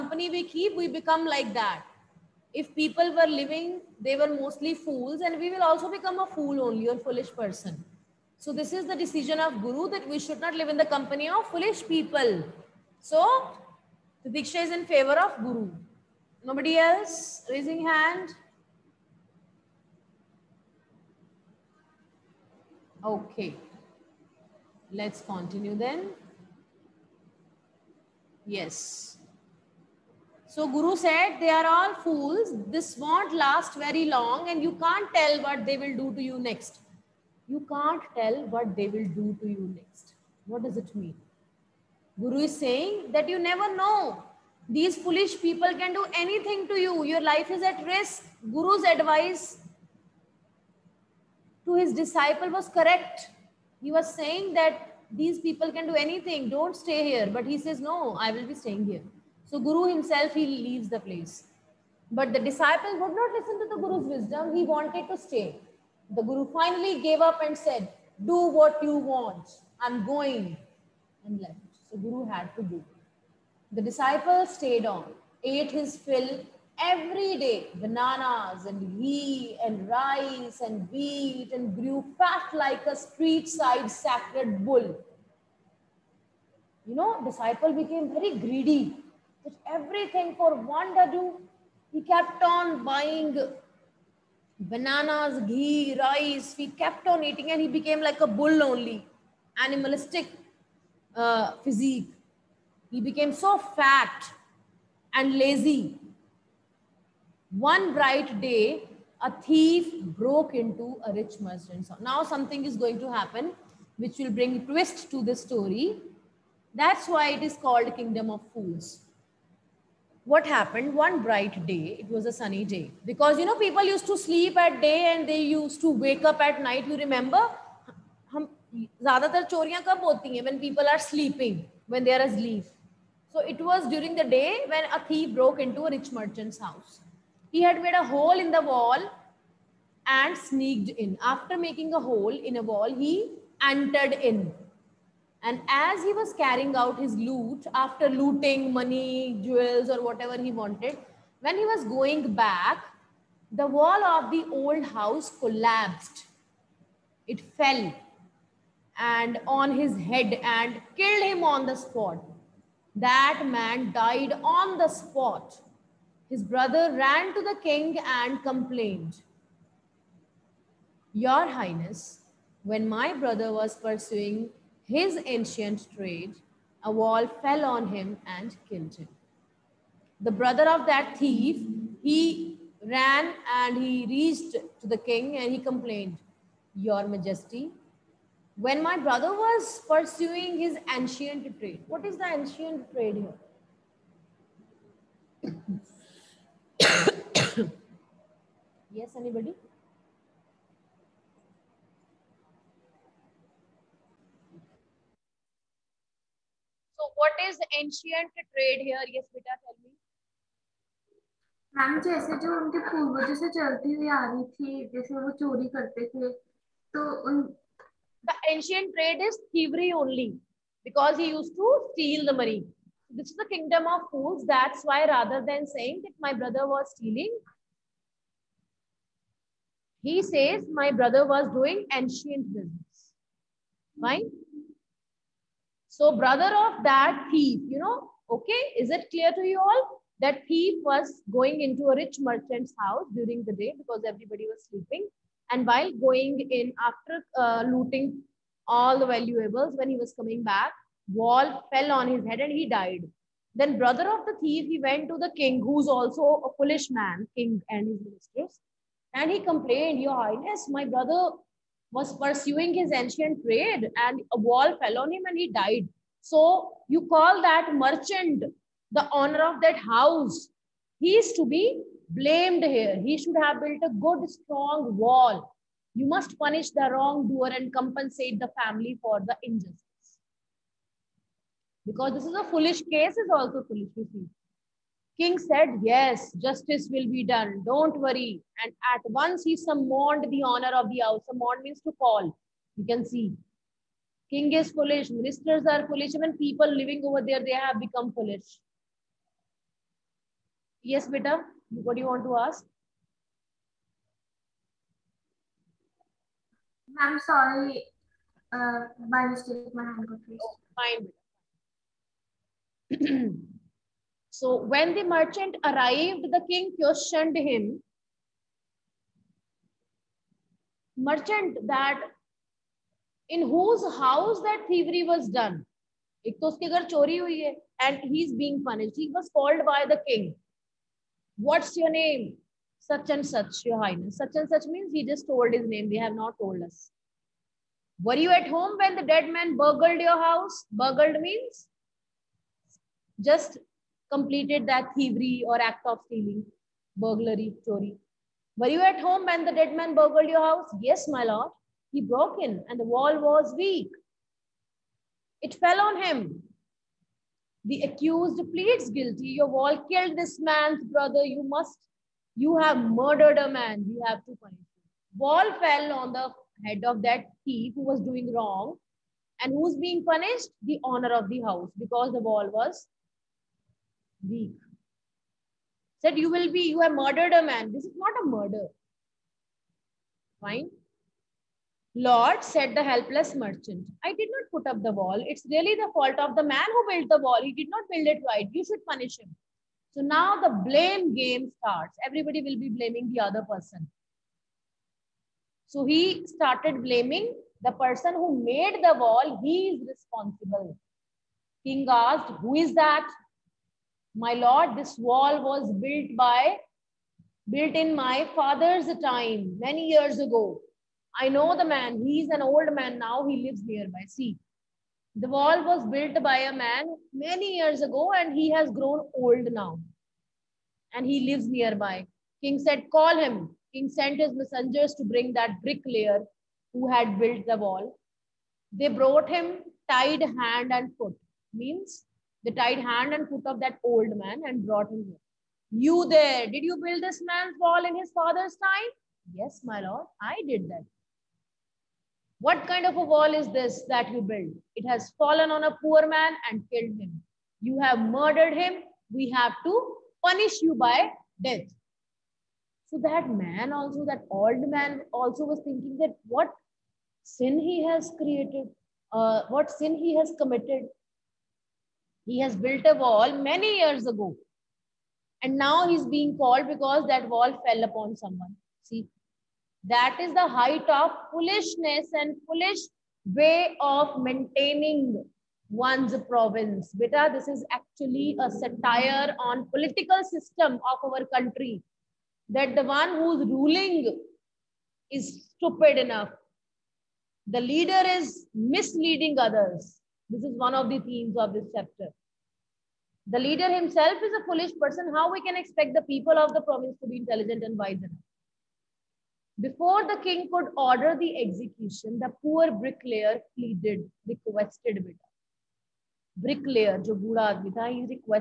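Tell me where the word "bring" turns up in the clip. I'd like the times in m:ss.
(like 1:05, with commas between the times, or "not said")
1:54, 7:05.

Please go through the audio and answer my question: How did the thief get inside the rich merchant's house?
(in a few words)
made a hole in the wall.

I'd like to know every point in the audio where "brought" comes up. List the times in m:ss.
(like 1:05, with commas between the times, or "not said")
7:08, 7:14.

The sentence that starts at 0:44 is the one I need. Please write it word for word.
These foolish people can do anything to you.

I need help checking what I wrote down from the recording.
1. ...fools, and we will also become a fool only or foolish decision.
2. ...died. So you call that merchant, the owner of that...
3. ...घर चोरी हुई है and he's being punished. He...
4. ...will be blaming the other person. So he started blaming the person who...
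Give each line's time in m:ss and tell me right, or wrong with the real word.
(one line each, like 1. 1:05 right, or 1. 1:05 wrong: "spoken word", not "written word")
1. 0:04 wrong: "person", not "decision"
2. 4:25 right
3. 5:26 right
4. 6:32 right.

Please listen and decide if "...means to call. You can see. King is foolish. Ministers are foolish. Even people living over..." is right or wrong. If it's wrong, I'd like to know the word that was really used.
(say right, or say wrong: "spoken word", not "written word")
right.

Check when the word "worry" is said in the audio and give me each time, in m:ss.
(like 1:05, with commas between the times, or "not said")
4:47.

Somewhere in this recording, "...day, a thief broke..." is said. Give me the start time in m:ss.
1:48.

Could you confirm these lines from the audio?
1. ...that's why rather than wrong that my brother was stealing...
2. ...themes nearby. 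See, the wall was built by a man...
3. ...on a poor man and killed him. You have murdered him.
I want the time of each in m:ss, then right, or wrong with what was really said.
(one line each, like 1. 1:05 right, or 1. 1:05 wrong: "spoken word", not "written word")
1. 3:44 wrong: "saying", not "wrong"
2. 6:53 wrong: "lives", not "themes"
3. 7:25 right.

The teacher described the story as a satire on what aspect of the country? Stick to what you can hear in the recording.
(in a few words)
political system.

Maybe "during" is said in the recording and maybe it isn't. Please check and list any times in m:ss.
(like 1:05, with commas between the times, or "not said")
2:13, 4:03.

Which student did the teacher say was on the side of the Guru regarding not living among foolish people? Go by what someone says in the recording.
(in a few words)
Titiksha.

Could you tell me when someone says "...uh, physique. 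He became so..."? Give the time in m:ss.
1:41.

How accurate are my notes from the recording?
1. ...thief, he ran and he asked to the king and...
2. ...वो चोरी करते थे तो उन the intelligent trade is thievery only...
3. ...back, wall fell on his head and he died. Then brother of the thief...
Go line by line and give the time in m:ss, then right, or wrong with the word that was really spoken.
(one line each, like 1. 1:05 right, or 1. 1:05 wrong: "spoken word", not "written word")
1. 3:01 wrong: "reached", not "asked"
2. 3:35 wrong: "ancient", not "intelligent"
3. 4:10 right.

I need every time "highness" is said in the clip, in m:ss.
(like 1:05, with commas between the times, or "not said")
2:51, 4:20, 5:33.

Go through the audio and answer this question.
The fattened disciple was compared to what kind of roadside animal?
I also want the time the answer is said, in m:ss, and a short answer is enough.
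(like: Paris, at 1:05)
sacred bull, at 1:23.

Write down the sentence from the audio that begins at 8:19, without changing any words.
Before the king could order the execution, the poor bricklayer pleaded, requested beta.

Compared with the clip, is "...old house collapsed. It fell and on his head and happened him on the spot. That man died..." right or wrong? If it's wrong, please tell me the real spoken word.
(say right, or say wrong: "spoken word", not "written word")
wrong: "killed", not "happened".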